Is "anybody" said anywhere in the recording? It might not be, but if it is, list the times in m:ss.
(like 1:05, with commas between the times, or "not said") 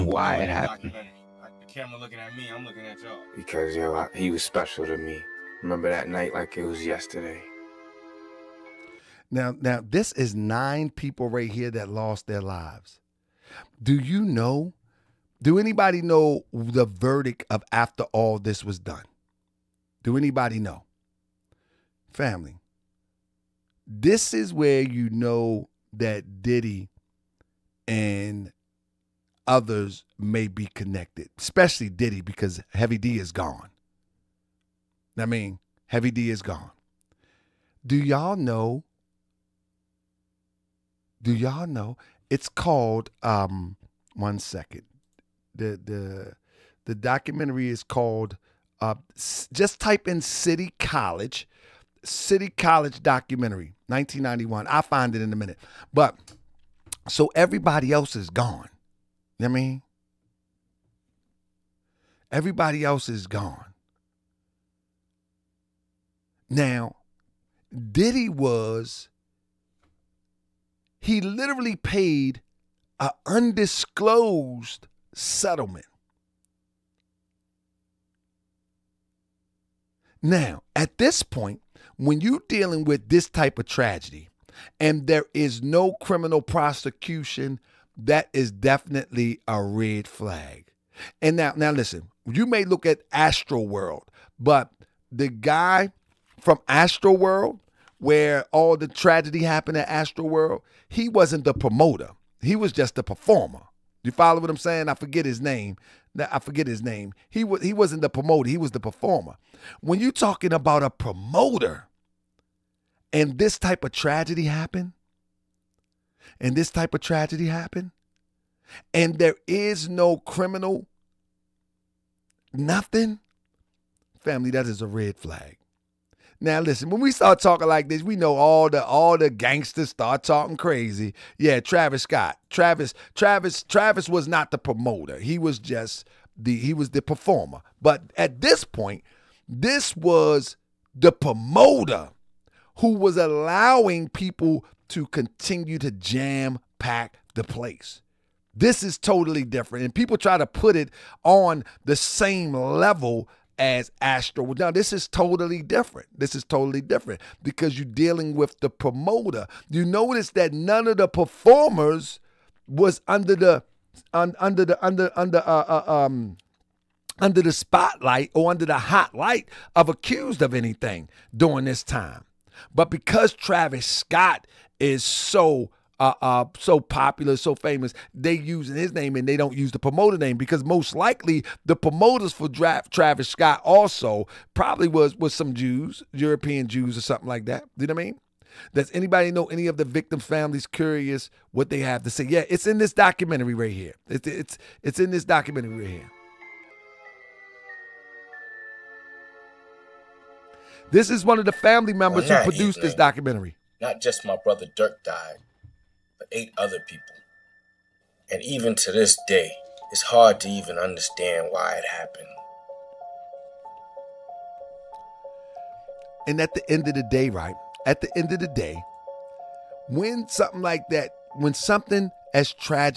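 0:15, 0:20, 3:08.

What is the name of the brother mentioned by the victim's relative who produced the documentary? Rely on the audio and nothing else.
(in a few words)
Dirk.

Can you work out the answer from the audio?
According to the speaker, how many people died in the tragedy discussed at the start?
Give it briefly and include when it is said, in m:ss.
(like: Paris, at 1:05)
9, at 0:10.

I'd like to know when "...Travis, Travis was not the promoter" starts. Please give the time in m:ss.
2:13.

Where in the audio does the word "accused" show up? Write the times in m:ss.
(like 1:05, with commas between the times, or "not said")
2:49.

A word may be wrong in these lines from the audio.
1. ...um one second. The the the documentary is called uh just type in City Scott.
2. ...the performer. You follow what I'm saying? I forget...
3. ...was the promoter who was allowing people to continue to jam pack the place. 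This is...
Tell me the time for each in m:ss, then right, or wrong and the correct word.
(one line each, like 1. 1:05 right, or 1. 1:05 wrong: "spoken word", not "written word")
1. 0:43 wrong: "College", not "Scott"
2. 1:42 right
3. 2:19 right.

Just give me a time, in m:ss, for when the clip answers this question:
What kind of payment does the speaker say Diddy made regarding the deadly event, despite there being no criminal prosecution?
1:13.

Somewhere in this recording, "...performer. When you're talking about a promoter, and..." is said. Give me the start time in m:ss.
1:48.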